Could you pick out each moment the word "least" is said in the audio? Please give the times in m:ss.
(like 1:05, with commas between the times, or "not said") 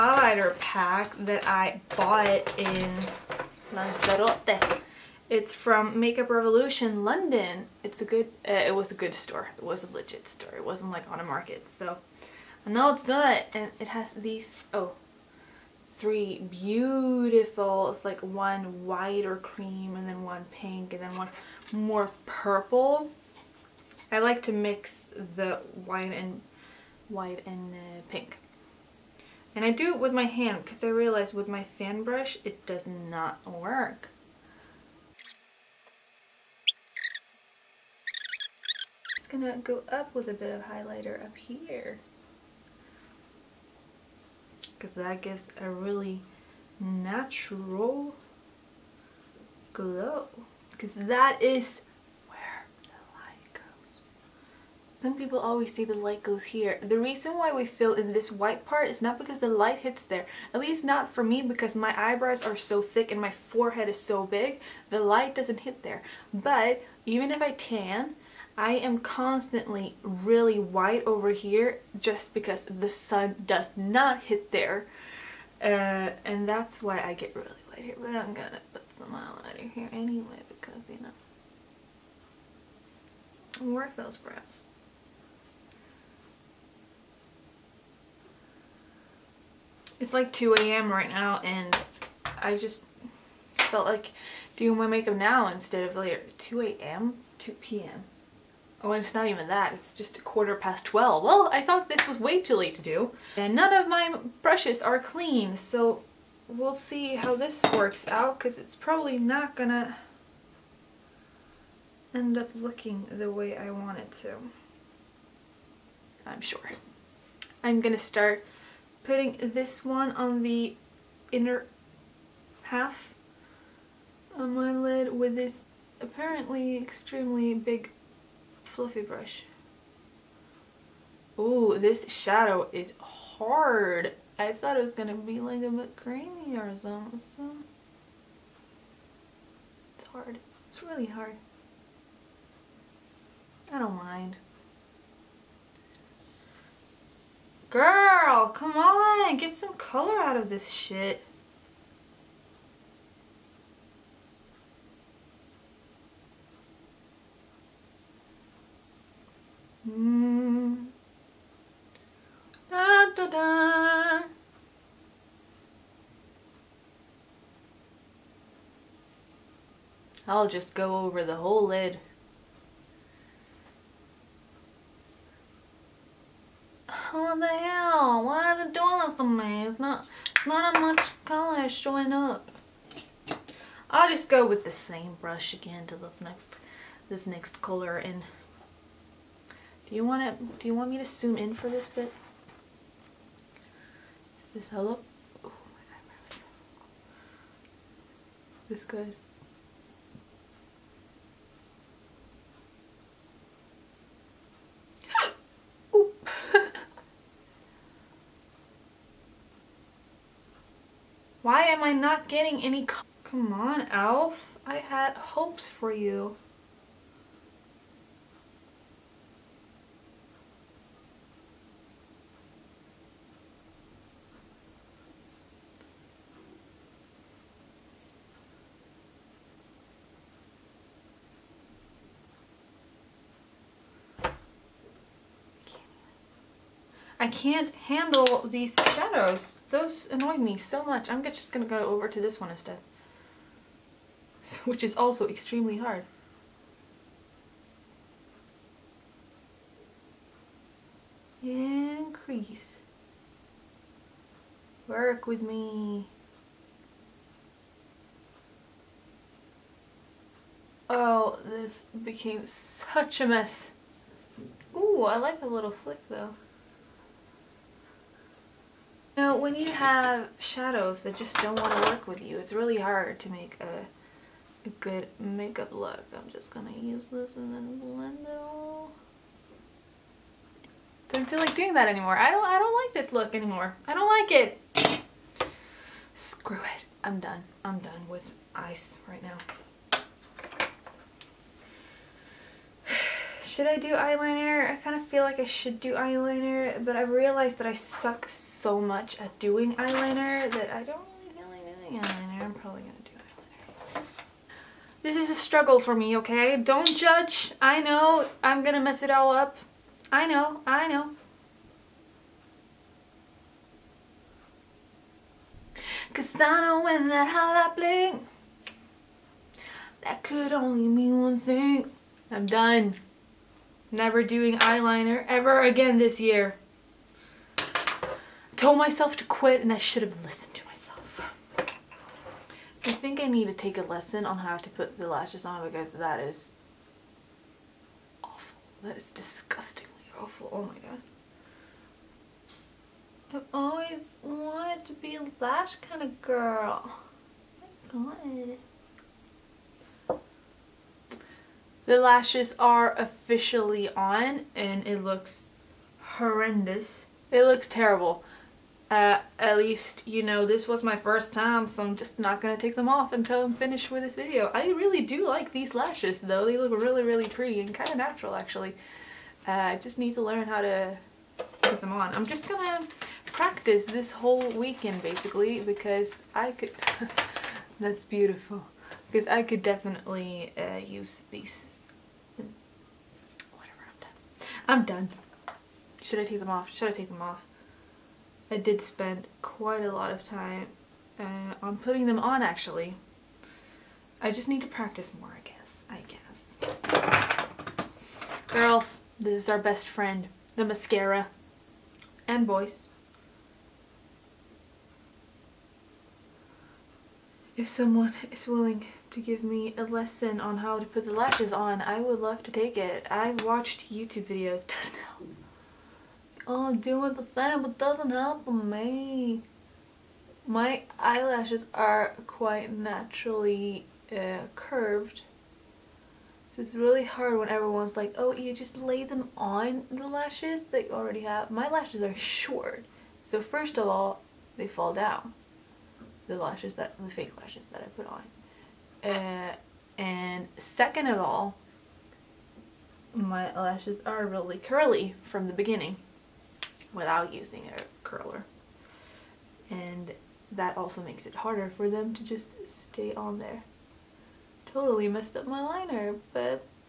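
1:00, 5:59.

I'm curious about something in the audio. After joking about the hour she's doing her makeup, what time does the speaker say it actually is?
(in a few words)
quarter past 12.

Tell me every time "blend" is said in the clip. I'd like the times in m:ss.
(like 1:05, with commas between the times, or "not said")
4:37.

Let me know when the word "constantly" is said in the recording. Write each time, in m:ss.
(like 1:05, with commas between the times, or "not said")
1:08.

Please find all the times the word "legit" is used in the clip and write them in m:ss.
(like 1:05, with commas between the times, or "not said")
0:09.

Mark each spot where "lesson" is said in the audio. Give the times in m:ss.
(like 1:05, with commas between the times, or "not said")
5:33, 6:49.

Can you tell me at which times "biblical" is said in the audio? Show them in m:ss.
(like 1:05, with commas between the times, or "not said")
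not said.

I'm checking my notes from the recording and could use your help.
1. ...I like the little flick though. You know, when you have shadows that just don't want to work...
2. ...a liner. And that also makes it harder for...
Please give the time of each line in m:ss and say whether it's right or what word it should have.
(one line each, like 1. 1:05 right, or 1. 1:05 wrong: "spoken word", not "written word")
1. 4:25 right
2. 7:27 wrong: "curler", not "liner".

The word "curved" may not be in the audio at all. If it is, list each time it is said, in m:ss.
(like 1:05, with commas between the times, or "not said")
7:04.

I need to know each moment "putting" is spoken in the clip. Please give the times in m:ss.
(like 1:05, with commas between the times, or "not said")
1:59, 6:31.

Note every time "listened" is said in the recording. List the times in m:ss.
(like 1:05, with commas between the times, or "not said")
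5:30.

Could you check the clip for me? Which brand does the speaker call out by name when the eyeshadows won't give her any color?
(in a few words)
Elf.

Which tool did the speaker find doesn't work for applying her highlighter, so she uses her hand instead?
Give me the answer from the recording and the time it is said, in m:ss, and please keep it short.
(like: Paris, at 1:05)
fan brush, at 0:31.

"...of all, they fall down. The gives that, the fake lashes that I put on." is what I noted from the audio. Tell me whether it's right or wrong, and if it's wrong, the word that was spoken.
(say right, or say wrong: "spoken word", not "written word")
wrong: "lashes", not "gives".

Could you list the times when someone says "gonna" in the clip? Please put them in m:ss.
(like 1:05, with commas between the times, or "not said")
0:39, 1:18, 1:49, 1:57, 4:01, 6:02, 6:12.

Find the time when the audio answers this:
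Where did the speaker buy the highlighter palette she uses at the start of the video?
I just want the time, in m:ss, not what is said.
0:03.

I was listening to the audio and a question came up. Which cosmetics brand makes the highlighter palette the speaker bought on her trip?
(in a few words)
Makeup Revolution London.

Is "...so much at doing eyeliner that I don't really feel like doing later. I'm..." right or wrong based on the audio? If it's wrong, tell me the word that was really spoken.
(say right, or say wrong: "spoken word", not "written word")
wrong: "eyeliner", not "later".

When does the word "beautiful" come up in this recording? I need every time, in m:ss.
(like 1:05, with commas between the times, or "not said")
0:16, 6:18.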